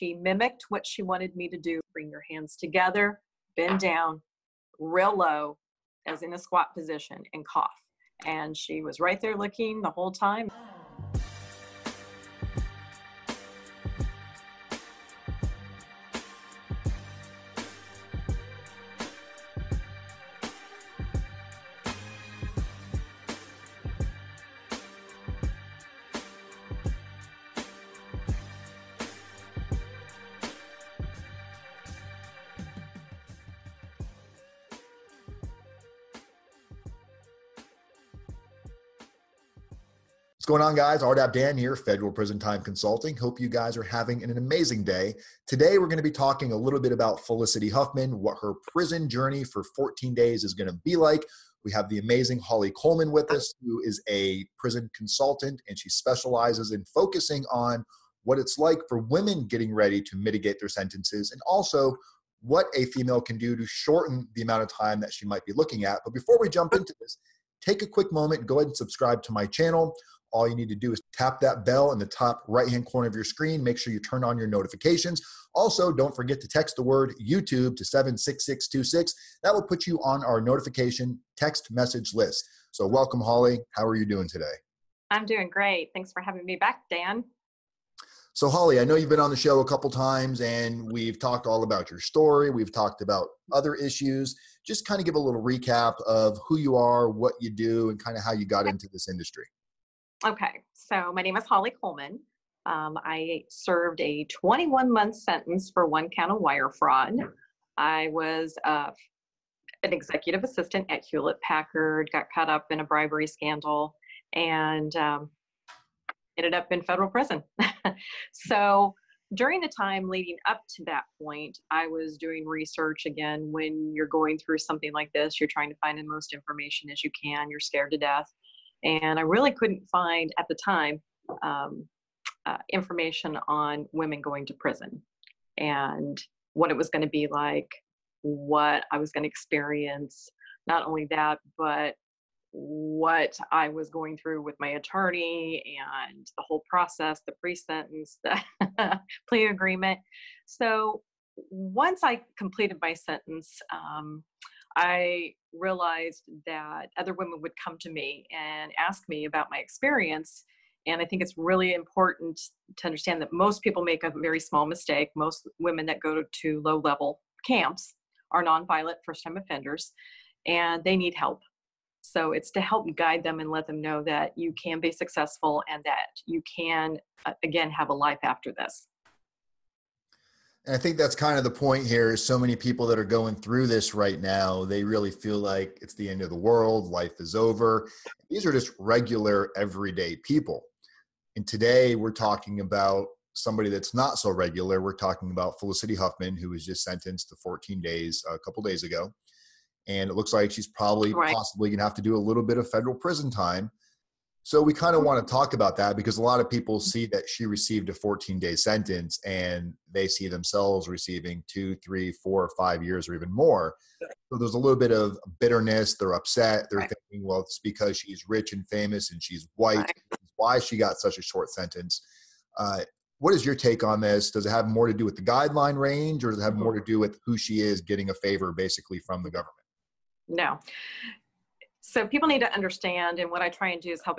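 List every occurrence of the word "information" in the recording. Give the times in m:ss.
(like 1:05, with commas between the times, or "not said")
2:06, 2:12.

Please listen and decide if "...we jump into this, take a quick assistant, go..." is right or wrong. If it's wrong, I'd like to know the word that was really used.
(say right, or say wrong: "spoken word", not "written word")
wrong: "moment", not "assistant".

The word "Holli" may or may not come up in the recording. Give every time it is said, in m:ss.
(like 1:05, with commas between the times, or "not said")
0:52, 1:23, 1:28, 1:41.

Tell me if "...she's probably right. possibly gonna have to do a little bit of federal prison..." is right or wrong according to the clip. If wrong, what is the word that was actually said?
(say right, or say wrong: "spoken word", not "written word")
right.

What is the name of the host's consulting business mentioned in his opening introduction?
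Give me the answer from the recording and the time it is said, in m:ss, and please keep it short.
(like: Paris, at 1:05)
Federal Prison Time Consulting, at 0:41.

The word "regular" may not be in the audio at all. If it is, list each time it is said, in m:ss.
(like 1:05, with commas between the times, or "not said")
3:08, 3:14.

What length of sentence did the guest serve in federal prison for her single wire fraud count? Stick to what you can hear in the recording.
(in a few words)
21 months.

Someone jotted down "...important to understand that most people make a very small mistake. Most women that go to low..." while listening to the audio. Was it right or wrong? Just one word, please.
right.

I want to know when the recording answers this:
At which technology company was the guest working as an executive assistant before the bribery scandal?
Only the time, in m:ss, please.
1:51.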